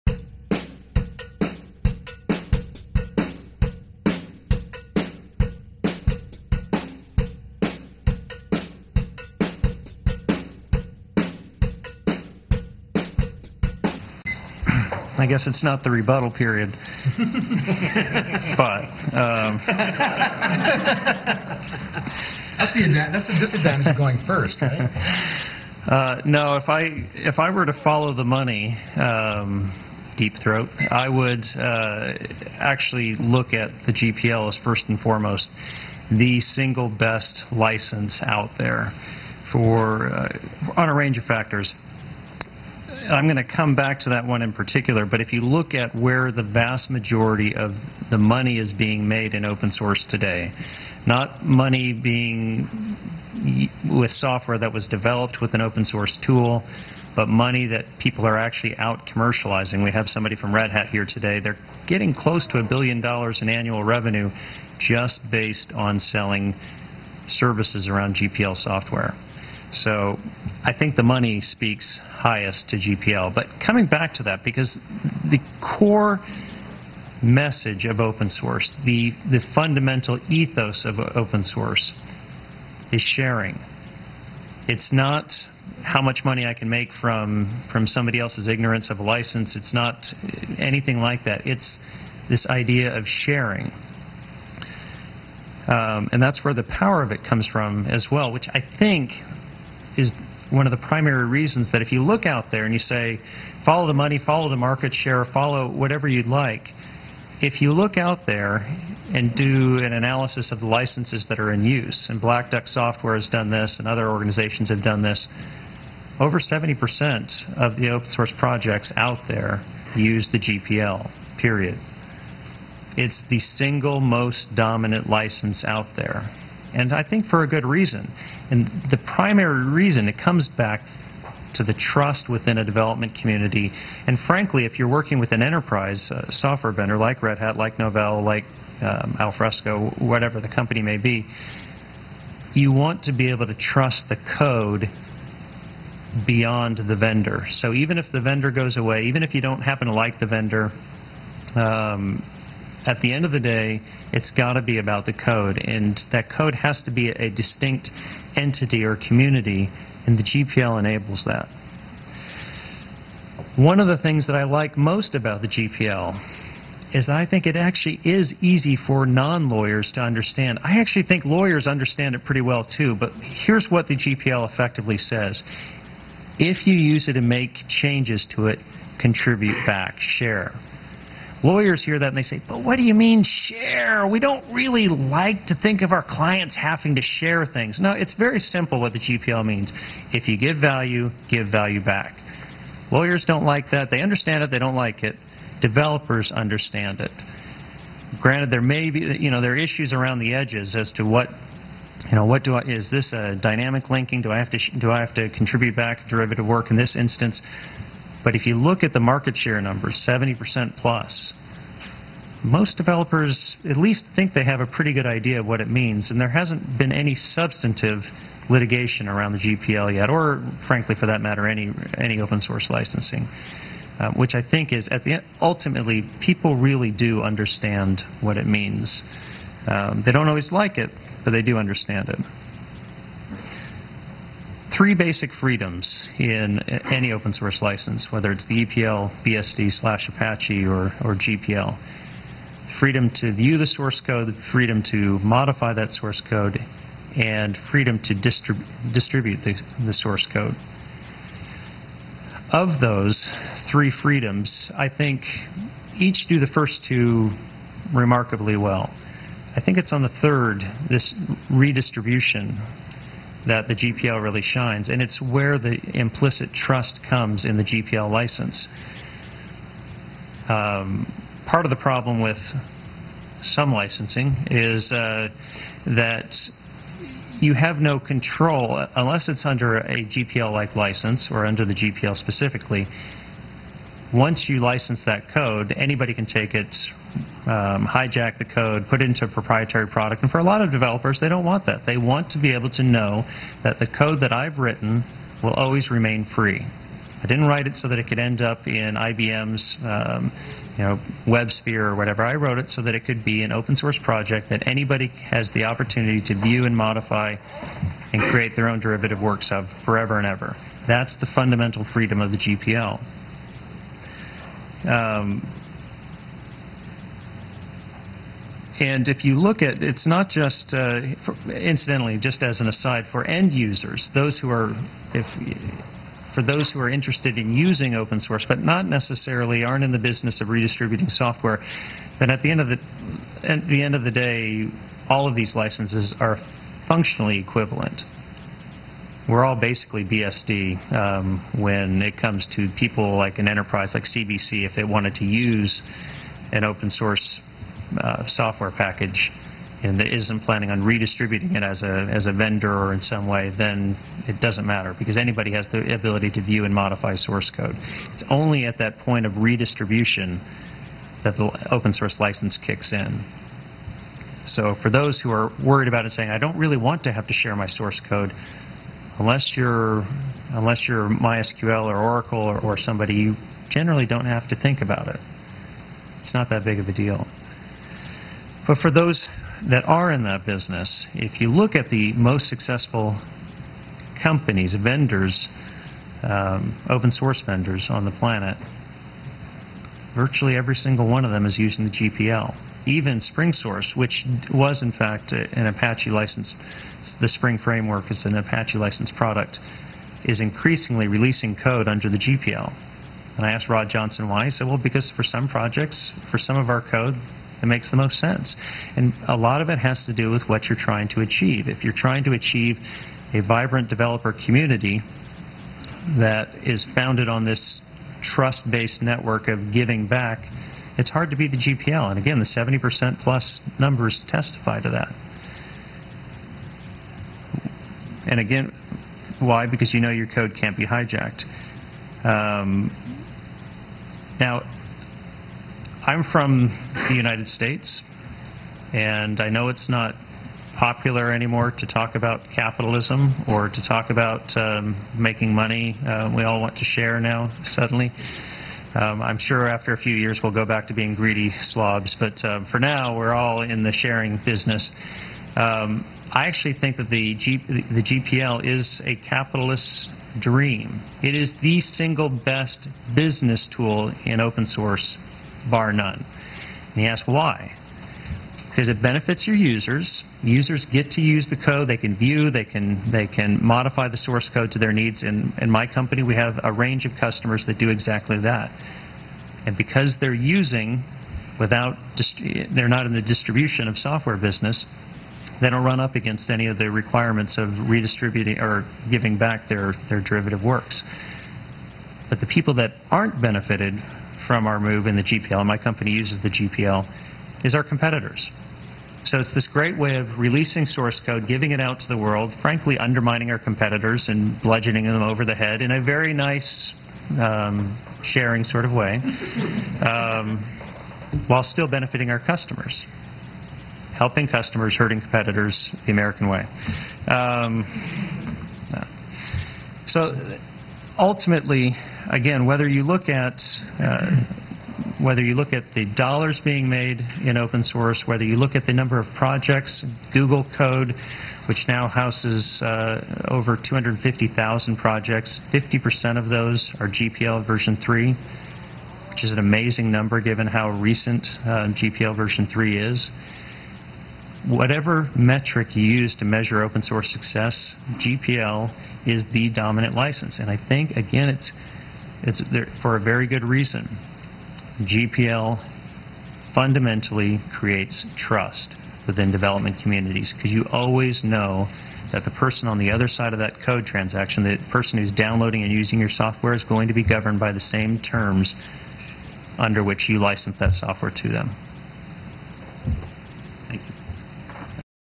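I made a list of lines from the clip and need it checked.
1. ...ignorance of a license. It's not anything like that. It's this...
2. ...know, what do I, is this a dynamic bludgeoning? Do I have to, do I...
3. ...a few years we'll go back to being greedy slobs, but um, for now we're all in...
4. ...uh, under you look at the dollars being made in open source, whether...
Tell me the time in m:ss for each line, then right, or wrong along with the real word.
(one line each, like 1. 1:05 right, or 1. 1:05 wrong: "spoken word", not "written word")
1. 1:28 right
2. 3:22 wrong: "linking", not "bludgeoning"
3. 7:29 right
4. 8:43 wrong: "whether", not "under".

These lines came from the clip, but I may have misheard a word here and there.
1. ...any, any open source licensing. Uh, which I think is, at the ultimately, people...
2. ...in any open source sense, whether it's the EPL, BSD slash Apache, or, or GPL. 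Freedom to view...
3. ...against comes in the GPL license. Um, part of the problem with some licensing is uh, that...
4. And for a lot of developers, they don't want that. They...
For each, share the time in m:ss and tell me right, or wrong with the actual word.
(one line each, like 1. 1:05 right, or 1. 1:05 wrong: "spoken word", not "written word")
1. 3:41 right
2. 3:56 wrong: "license", not "sense"
3. 4:26 wrong: "trust", not "against"
4. 4:50 right.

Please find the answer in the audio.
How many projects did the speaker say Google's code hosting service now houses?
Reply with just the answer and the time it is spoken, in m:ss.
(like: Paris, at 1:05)
over 250,000, at 8:53.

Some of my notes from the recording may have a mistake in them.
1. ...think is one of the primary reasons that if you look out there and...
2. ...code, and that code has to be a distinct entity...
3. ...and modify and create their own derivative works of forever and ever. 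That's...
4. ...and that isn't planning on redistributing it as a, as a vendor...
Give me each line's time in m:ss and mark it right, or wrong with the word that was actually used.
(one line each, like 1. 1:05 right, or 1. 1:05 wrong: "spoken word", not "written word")
1. 1:38 right
2. 2:35 right
3. 5:06 right
4. 5:49 right.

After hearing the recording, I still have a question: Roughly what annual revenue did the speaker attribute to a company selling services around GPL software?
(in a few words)
a billion dollars.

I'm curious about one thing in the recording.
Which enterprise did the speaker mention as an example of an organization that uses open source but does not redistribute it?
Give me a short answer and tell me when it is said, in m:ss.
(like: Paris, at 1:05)
CBC, at 5:44.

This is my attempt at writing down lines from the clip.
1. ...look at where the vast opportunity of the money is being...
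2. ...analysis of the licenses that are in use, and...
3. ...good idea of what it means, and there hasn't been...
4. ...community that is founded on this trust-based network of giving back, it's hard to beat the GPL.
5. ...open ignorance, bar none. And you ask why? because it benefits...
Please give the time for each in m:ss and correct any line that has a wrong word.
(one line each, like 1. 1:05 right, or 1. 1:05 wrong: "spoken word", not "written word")
1. 0:45 wrong: "majority", not "opportunity"
2. 1:49 right
3. 3:34 right
4. 6:54 right
5. 7:44 wrong: "source", not "ignorance".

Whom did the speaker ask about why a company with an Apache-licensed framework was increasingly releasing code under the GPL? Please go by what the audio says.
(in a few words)
Rod Johnson.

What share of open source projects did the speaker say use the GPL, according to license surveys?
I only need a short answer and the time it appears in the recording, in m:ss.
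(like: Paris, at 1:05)
over 70%, at 1:56.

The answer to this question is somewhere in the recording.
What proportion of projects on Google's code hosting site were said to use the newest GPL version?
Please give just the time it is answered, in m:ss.
8:55.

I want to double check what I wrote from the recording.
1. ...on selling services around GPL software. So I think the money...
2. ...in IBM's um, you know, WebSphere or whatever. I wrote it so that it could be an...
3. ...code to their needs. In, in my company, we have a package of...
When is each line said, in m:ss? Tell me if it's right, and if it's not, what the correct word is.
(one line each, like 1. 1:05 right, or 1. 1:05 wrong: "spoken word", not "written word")
1. 1:05 right
2. 4:58 right
3. 7:54 wrong: "range", not "package".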